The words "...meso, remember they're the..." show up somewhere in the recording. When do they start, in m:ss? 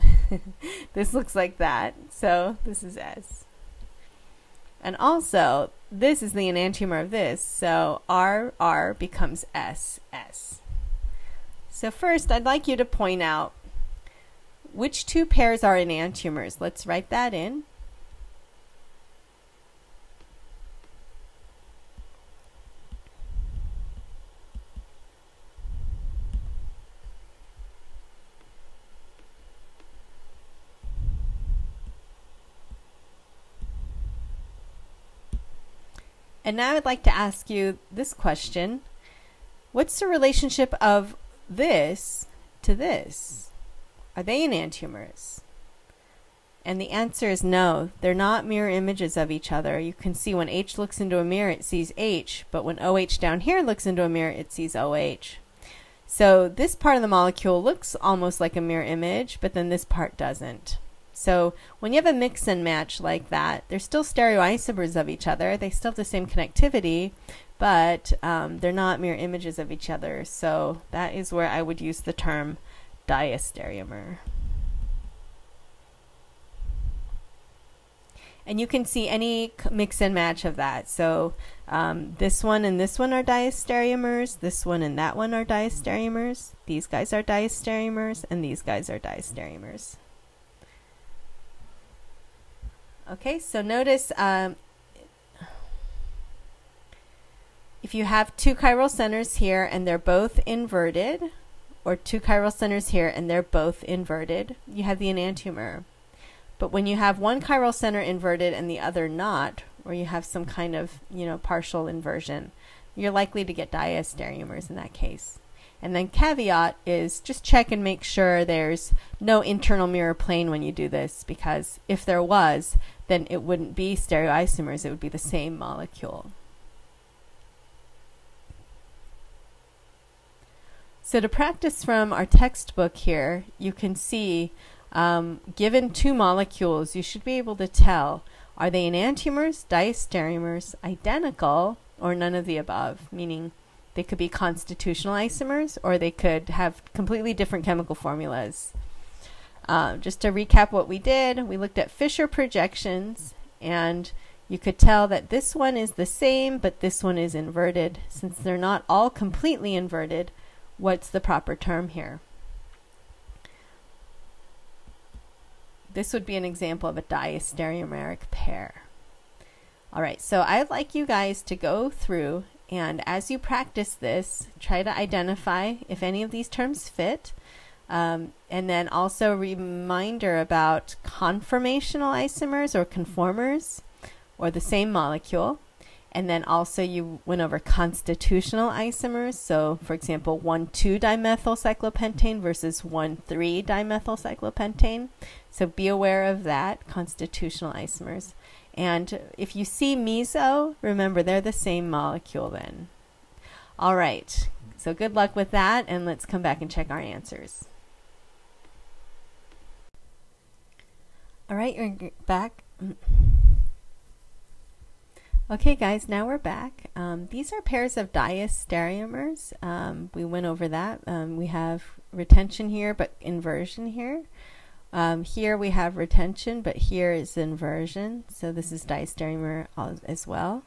3:19.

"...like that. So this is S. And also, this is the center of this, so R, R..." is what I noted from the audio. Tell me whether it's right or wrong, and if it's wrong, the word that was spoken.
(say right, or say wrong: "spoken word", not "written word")
wrong: "enantiomer", not "center".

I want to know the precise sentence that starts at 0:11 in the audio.
So first, I'd like you to point out which two pairs are enantiomers.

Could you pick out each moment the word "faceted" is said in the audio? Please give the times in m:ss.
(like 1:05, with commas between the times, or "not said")
not said.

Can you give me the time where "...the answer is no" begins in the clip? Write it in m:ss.
0:46.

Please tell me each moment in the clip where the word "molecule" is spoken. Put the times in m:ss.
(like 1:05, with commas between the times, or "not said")
0:57, 2:05, 2:16, 3:04, 3:21.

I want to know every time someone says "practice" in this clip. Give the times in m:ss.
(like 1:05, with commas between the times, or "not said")
2:11, 2:53.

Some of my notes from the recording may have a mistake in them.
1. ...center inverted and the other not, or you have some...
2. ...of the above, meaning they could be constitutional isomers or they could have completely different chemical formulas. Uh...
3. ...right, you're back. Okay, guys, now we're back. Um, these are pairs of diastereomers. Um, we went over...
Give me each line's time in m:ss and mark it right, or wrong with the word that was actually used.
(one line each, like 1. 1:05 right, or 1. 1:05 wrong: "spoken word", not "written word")
1. 1:47 right
2. 2:22 right
3. 3:31 right.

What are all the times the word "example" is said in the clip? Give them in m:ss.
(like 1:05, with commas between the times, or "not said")
2:46, 3:09.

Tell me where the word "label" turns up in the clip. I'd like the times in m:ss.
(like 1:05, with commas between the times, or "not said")
not said.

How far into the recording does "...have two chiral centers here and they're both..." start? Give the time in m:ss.
1:38.